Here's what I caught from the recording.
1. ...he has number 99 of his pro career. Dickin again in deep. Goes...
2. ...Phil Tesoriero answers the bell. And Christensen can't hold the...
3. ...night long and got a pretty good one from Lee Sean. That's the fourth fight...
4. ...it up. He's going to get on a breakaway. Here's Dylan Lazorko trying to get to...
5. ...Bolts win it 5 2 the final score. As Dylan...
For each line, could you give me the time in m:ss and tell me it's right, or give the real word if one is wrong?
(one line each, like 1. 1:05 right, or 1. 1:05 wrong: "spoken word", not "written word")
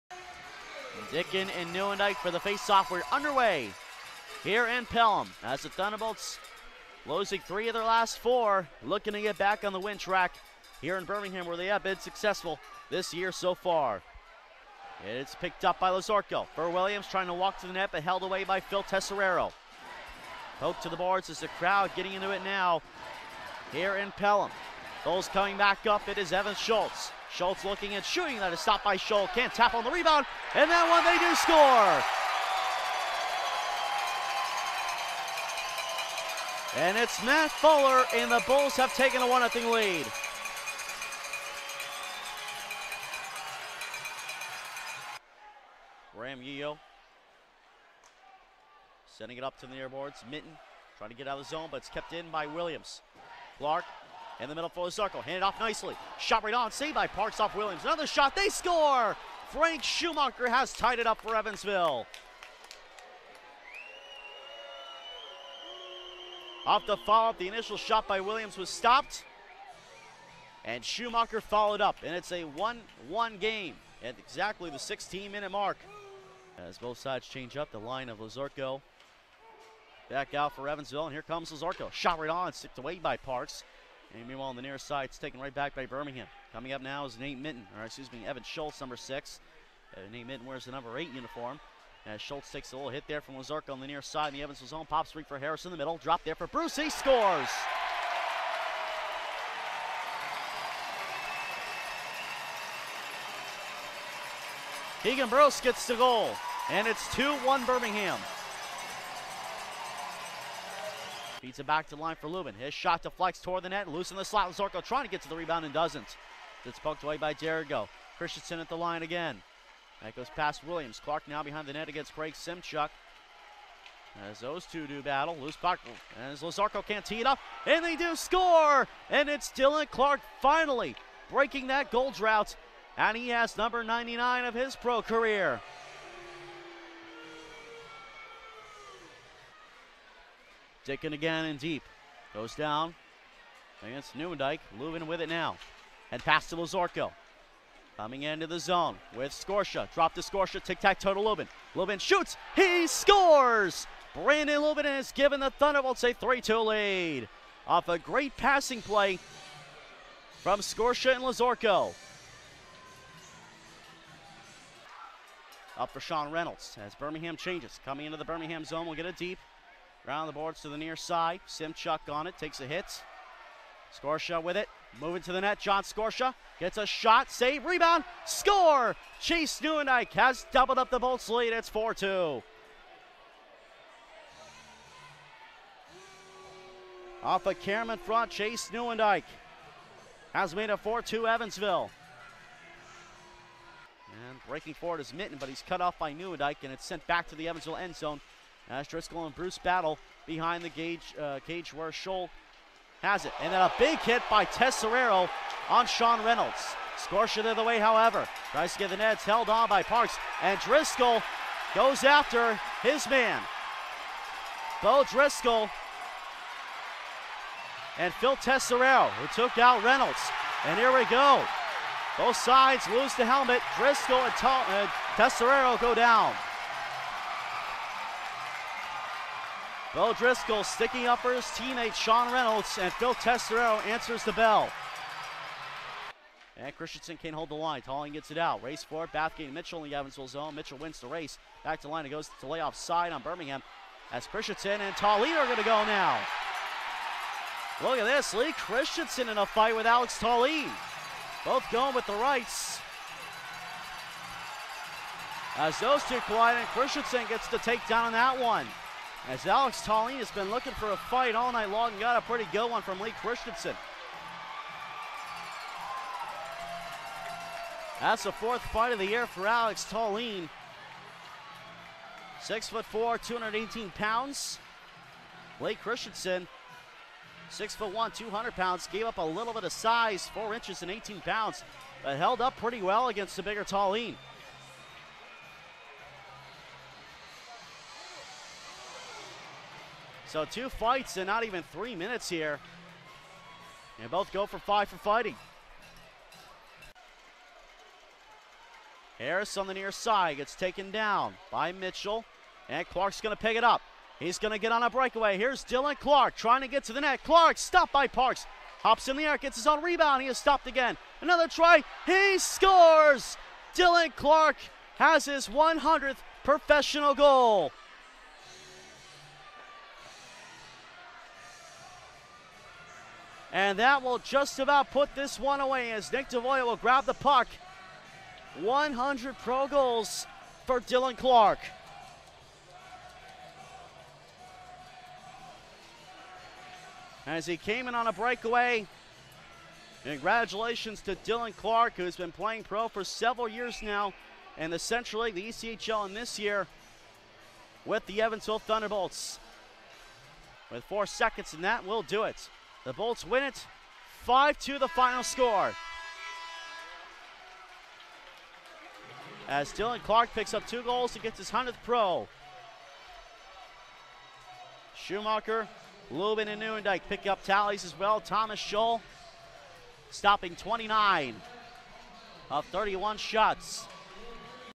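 1. 2:13 right
2. 3:52 right
3. 4:21 wrong: "Christensen", not "Sean"
4. 5:03 wrong: "Clarke", not "Lazorko"
5. 5:52 right.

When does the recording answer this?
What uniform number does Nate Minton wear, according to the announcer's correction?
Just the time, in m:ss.
1:30.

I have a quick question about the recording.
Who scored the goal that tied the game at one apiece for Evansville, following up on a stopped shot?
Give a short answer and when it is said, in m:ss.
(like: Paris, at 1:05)
Frank Schumacher, at 0:59.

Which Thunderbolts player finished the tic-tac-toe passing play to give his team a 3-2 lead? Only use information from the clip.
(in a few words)
Brandon Lubin.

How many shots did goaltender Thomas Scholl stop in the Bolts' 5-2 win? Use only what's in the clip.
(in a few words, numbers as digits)
29.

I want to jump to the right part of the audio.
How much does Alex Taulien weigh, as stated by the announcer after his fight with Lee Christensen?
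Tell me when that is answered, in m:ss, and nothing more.
4:33.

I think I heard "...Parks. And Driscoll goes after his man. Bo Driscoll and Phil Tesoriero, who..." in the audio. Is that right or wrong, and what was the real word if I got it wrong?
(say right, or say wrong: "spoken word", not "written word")
right.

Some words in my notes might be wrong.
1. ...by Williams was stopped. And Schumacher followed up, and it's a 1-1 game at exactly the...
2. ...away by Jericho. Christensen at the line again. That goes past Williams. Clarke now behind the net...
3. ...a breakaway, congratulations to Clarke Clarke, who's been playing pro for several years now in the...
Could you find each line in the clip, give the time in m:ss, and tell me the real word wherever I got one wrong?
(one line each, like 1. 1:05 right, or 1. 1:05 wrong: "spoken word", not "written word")
1. 1:08 right
2. 1:57 right
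3. 5:38 wrong: "Dylan", not "Clarke".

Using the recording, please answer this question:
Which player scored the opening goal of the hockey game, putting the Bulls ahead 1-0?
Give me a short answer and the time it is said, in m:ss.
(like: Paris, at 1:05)
Matt Fuller, at 0:37.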